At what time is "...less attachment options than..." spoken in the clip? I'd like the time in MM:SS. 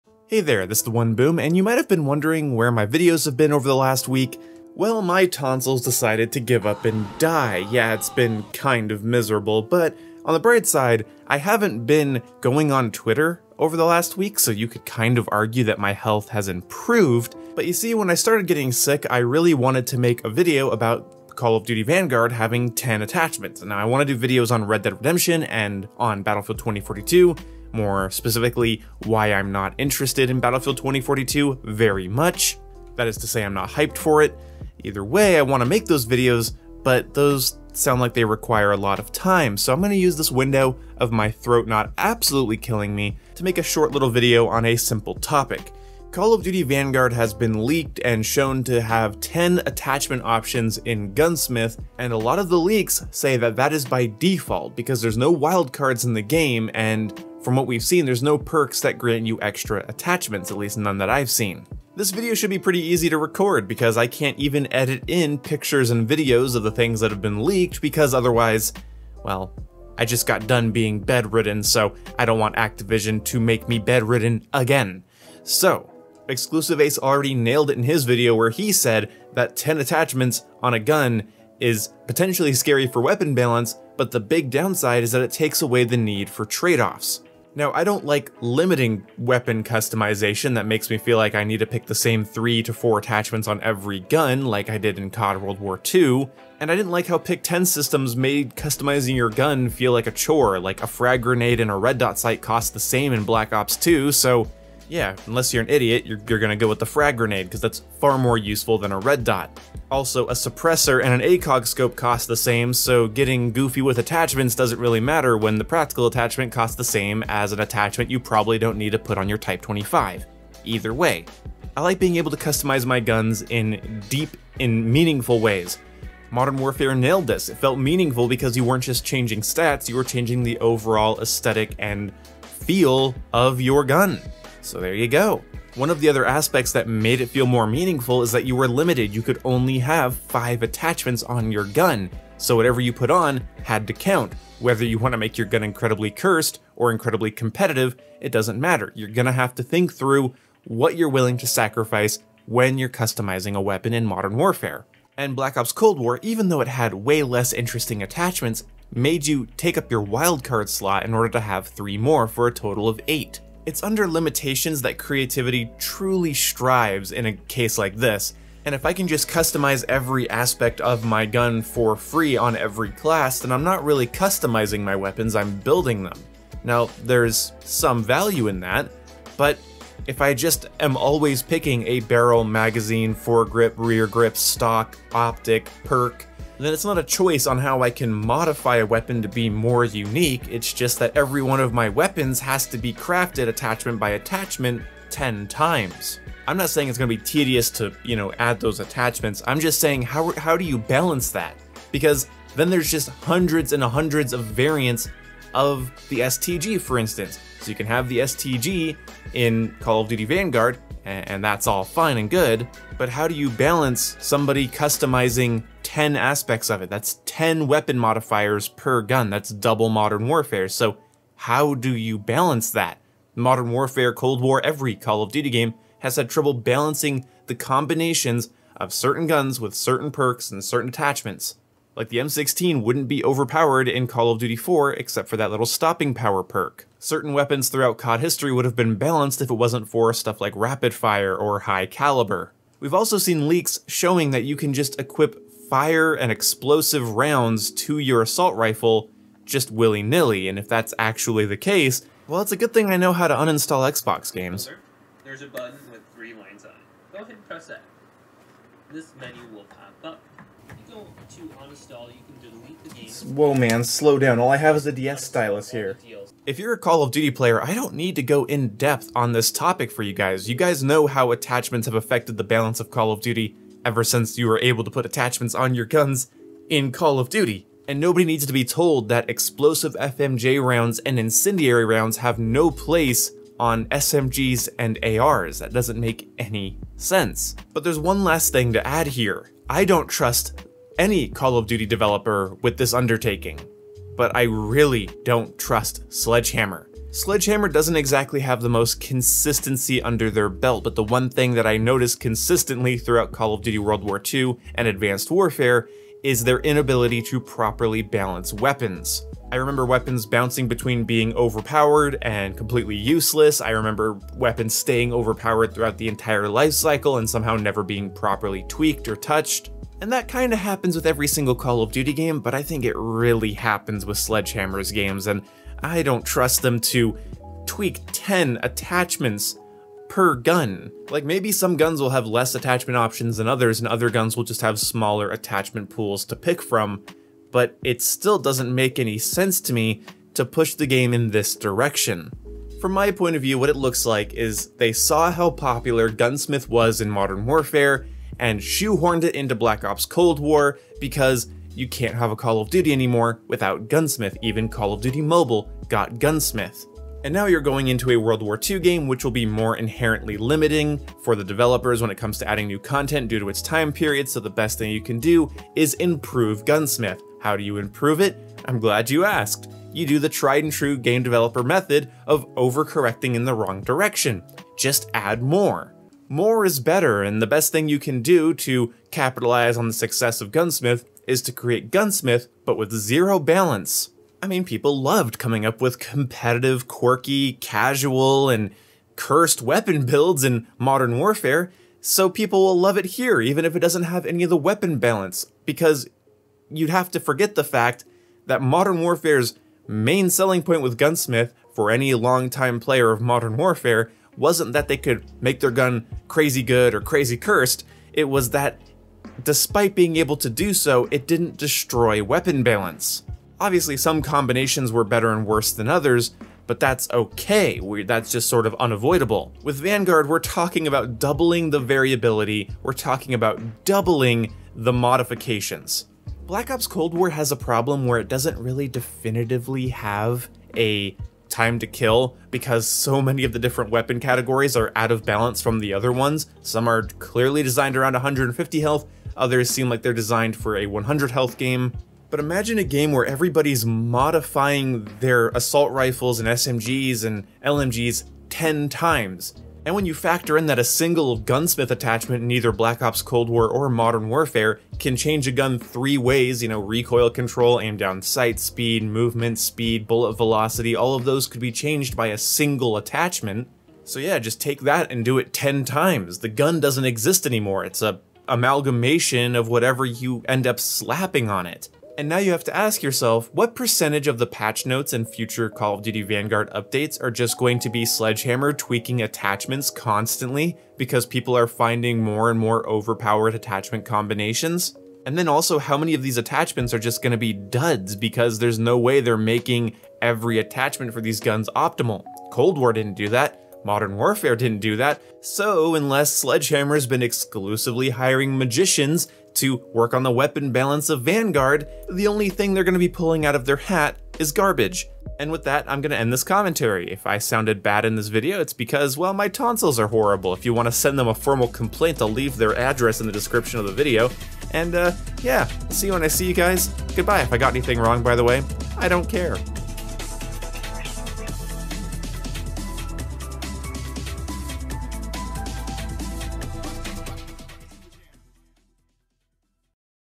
05:32.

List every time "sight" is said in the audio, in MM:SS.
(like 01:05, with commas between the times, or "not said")
01:42, 07:38.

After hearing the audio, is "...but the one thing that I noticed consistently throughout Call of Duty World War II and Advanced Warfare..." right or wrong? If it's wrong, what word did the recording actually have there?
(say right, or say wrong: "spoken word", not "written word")
right.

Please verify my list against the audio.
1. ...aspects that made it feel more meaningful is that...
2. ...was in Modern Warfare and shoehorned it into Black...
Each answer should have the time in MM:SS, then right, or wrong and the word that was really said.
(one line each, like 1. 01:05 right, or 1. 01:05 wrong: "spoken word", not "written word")
1. 02:16 right
2. 05:46 right.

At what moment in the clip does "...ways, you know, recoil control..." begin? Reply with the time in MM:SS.
07:36.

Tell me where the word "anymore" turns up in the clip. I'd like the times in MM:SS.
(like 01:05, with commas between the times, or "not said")
05:52, 07:47.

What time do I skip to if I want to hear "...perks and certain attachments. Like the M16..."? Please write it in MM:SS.
03:50.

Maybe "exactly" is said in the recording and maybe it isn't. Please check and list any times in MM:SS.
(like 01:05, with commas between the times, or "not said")
04:57.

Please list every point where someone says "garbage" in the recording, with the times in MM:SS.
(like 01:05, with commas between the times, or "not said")
08:24.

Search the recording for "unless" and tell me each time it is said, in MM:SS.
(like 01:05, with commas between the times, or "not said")
01:45, 08:15.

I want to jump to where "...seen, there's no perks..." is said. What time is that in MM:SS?
00:57.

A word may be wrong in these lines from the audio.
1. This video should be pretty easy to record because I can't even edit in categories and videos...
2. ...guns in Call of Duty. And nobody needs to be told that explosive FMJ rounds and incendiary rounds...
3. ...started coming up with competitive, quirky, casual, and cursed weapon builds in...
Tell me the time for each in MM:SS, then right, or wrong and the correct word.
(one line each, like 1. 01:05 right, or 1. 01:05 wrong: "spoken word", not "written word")
1. 01:01 wrong: "pictures", not "categories"
2. 04:35 right
3. 06:24 wrong: "loved", not "started".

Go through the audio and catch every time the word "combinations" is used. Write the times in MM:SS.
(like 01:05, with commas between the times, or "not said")
03:47, 06:54, 08:04.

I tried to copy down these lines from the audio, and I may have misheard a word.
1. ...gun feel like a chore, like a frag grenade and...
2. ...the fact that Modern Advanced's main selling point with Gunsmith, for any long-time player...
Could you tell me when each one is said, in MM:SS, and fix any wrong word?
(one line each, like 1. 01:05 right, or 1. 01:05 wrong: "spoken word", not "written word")
1. 01:39 right
2. 06:37 wrong: "Warfare", not "Advanced".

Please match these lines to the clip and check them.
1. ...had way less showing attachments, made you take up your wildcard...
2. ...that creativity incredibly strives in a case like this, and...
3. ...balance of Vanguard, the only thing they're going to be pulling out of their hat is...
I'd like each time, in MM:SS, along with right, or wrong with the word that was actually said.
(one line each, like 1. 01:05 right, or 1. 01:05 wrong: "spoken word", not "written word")
1. 02:36 wrong: "interesting", not "showing"
2. 02:44 wrong: "truly", not "incredibly"
3. 08:20 right.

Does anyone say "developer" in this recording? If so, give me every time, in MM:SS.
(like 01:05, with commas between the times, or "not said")
04:51, 06:01, 06:11.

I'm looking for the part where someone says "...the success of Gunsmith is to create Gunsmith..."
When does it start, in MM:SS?
06:19.